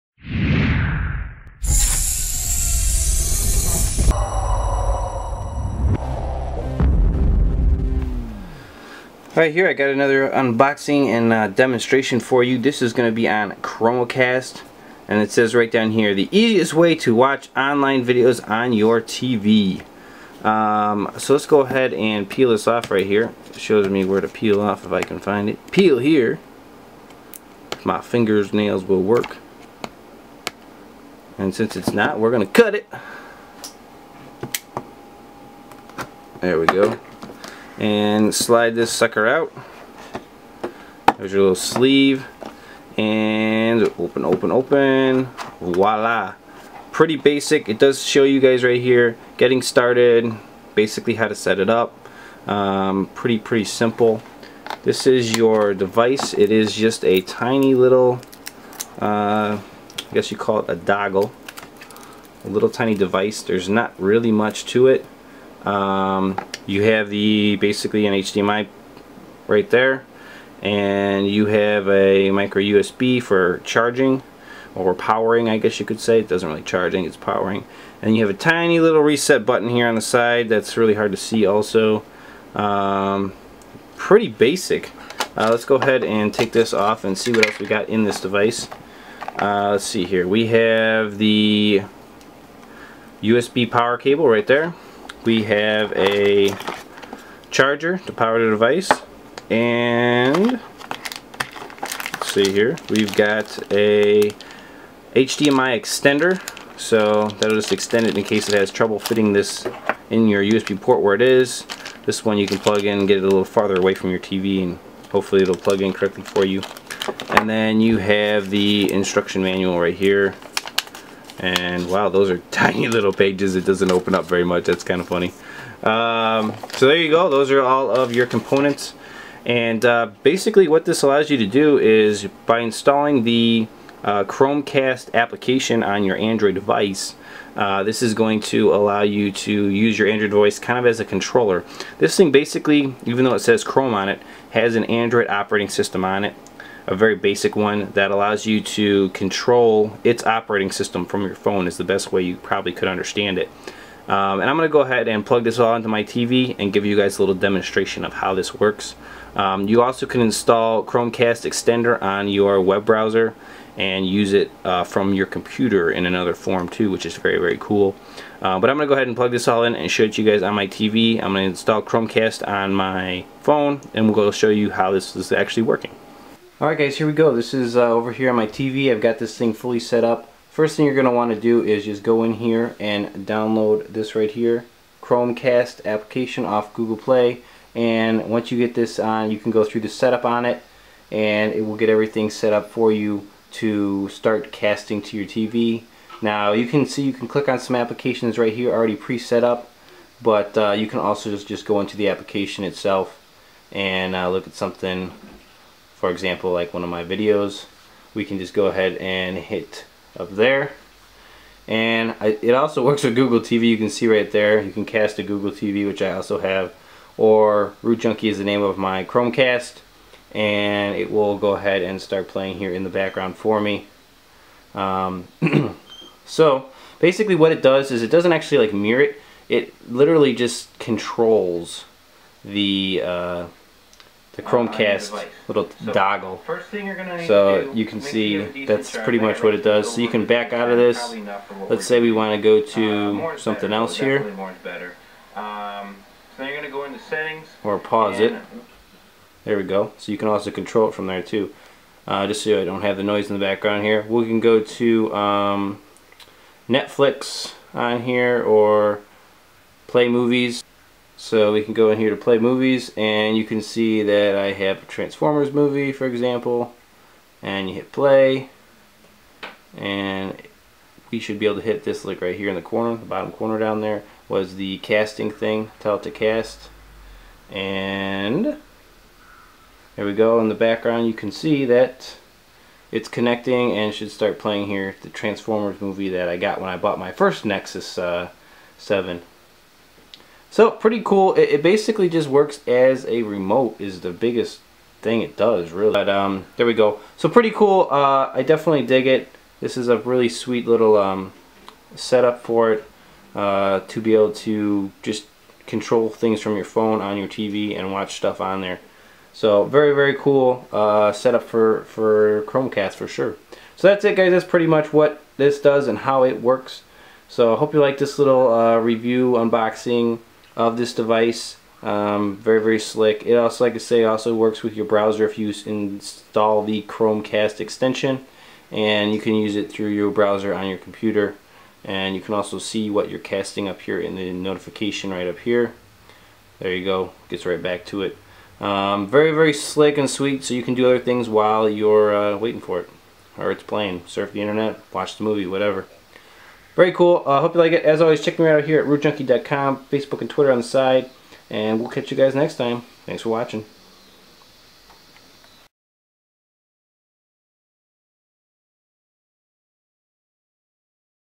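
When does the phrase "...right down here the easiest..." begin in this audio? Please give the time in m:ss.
0:15.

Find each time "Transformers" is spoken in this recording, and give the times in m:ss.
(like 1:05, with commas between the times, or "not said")
4:24, 4:45.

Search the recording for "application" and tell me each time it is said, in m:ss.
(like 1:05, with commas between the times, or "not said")
2:15, 3:05, 3:17, 3:22.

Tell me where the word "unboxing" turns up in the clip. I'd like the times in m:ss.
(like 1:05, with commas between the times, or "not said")
0:10, 5:19.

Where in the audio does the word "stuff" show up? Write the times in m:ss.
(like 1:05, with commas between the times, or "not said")
5:08.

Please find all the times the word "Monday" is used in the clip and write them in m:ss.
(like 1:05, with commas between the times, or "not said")
not said.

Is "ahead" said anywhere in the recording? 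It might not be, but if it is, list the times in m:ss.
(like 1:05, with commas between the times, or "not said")
0:21, 1:25, 2:34, 2:48, 3:28, 3:41.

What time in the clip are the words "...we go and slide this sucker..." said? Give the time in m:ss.
0:36.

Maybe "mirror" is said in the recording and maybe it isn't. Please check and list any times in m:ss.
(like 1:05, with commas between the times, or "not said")
3:48.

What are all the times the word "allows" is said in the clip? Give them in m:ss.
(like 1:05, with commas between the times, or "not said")
2:11, 2:18, 2:28.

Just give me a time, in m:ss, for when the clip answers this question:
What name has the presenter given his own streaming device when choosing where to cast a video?
3:37.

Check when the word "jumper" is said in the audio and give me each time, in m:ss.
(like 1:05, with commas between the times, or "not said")
not said.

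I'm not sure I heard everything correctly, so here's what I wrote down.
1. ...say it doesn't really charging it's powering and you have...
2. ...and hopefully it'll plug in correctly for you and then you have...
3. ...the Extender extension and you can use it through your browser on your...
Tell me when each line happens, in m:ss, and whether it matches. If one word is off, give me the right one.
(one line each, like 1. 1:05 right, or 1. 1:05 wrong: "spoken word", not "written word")
1. 1:15 right
2. 1:54 right
3. 5:26 wrong: "Chromecast", not "Extender".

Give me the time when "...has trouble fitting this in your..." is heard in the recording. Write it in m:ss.
1:48.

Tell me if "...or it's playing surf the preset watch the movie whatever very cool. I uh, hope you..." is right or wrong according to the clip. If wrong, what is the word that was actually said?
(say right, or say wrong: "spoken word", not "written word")
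wrong: "internet", not "preset".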